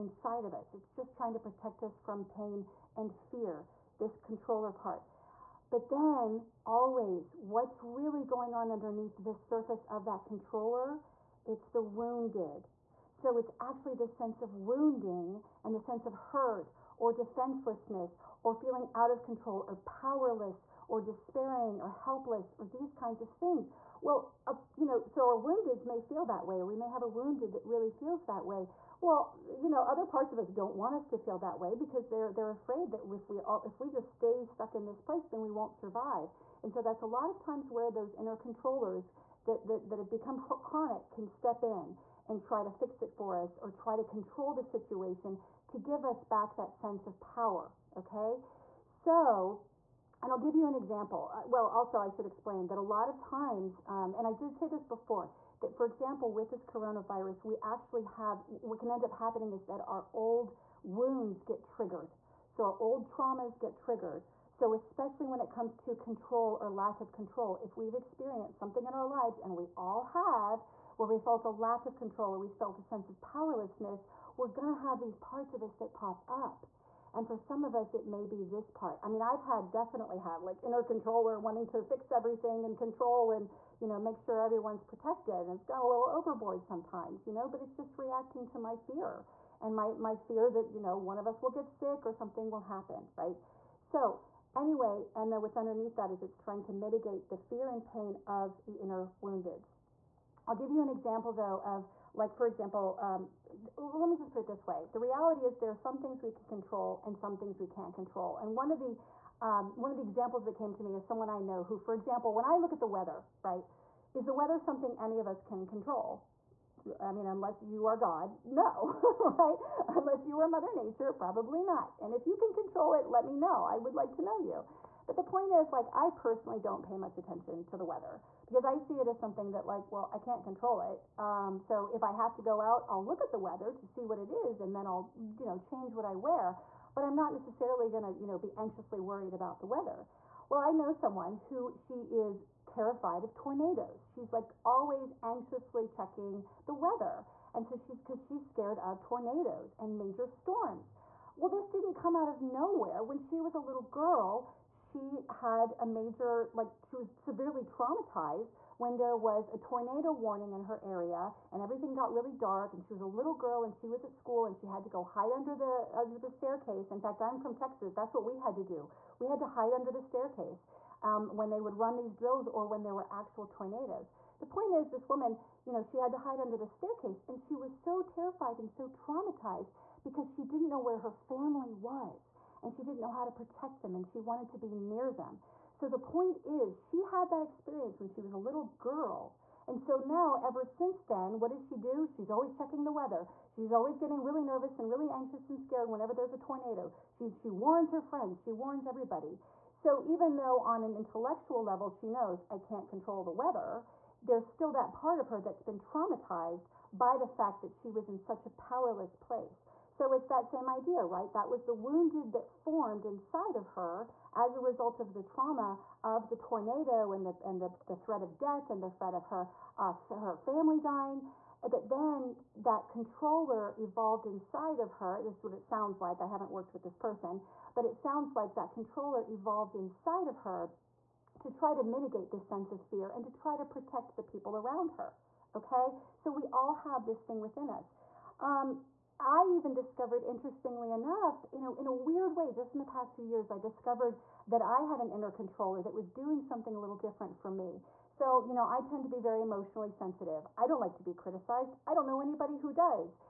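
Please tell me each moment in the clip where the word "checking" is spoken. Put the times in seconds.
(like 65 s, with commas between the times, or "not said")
145 s, 192 s.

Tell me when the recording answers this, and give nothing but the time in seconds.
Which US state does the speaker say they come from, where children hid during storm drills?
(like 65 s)
167 s.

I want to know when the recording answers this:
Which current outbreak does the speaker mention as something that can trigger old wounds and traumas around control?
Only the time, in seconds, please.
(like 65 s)
56 s.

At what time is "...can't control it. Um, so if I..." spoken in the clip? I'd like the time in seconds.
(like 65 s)
130 s.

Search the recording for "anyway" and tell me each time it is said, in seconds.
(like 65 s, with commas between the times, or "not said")
94 s.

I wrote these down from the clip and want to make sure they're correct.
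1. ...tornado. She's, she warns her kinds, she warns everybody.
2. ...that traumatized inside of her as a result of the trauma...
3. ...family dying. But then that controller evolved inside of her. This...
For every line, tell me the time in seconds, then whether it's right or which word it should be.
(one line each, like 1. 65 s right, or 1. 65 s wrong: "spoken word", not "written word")
1. 196 s wrong: "friends", not "kinds"
2. 212 s wrong: "formed", not "traumatized"
3. 220 s right.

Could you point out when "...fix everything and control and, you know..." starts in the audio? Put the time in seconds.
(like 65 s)
81 s.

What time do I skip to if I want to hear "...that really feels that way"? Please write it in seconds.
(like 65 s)
27 s.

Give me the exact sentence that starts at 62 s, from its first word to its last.
So our old traumas get triggered.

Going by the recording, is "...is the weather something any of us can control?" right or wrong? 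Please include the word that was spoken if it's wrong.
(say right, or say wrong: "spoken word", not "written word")
right.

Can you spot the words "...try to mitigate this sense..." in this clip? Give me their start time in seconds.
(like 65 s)
231 s.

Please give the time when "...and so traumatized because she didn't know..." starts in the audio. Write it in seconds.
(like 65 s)
178 s.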